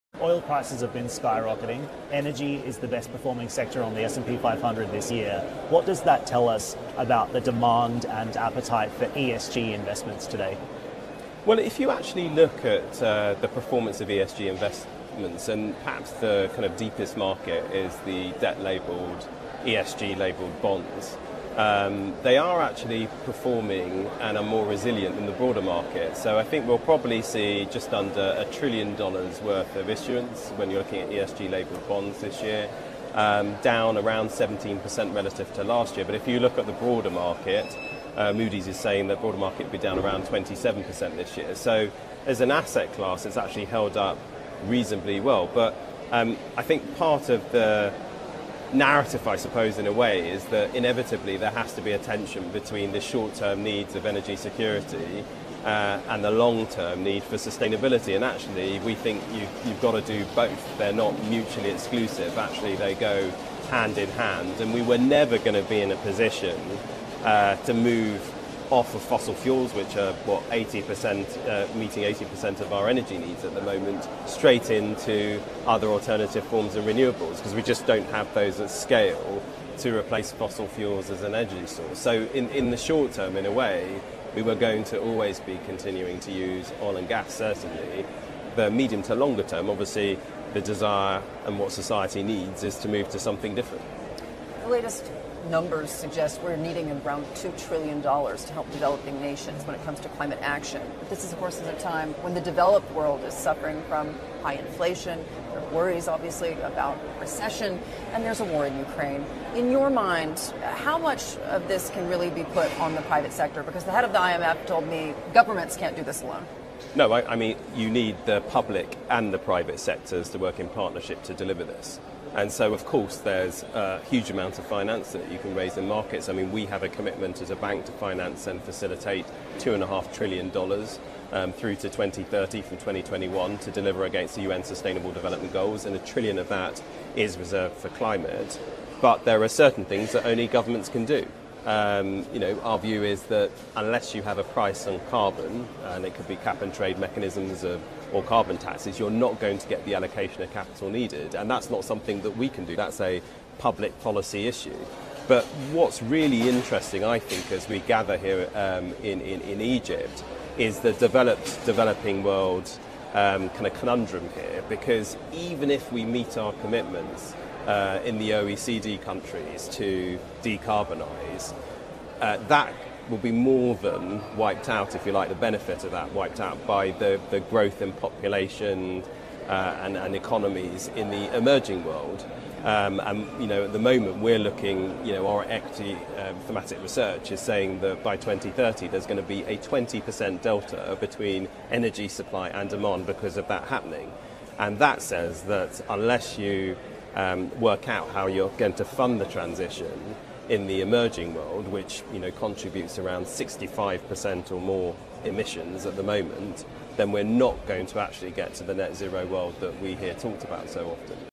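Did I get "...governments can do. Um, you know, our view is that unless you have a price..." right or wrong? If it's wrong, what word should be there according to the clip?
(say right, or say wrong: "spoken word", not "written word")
right.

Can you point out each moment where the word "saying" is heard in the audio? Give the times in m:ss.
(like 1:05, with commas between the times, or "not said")
0:38, 3:07.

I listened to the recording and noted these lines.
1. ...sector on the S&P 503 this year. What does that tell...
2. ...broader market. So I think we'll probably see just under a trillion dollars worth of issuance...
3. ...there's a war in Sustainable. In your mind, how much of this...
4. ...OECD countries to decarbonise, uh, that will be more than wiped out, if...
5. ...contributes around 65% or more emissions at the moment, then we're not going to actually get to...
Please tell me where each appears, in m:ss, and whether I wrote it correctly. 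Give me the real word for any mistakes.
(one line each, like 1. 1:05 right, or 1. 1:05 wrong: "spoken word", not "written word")
1. 0:03 wrong: "500", not "503"
2. 0:25 right
3. 1:48 wrong: "Ukraine", not "Sustainable"
4. 2:48 right
5. 3:22 right.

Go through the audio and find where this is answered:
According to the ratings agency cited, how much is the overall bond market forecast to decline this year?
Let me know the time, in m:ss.
0:40.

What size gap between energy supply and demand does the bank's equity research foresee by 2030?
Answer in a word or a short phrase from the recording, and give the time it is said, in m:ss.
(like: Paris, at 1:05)
20%, at 3:09.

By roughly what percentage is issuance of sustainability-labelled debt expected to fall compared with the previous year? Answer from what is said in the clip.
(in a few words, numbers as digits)
17%.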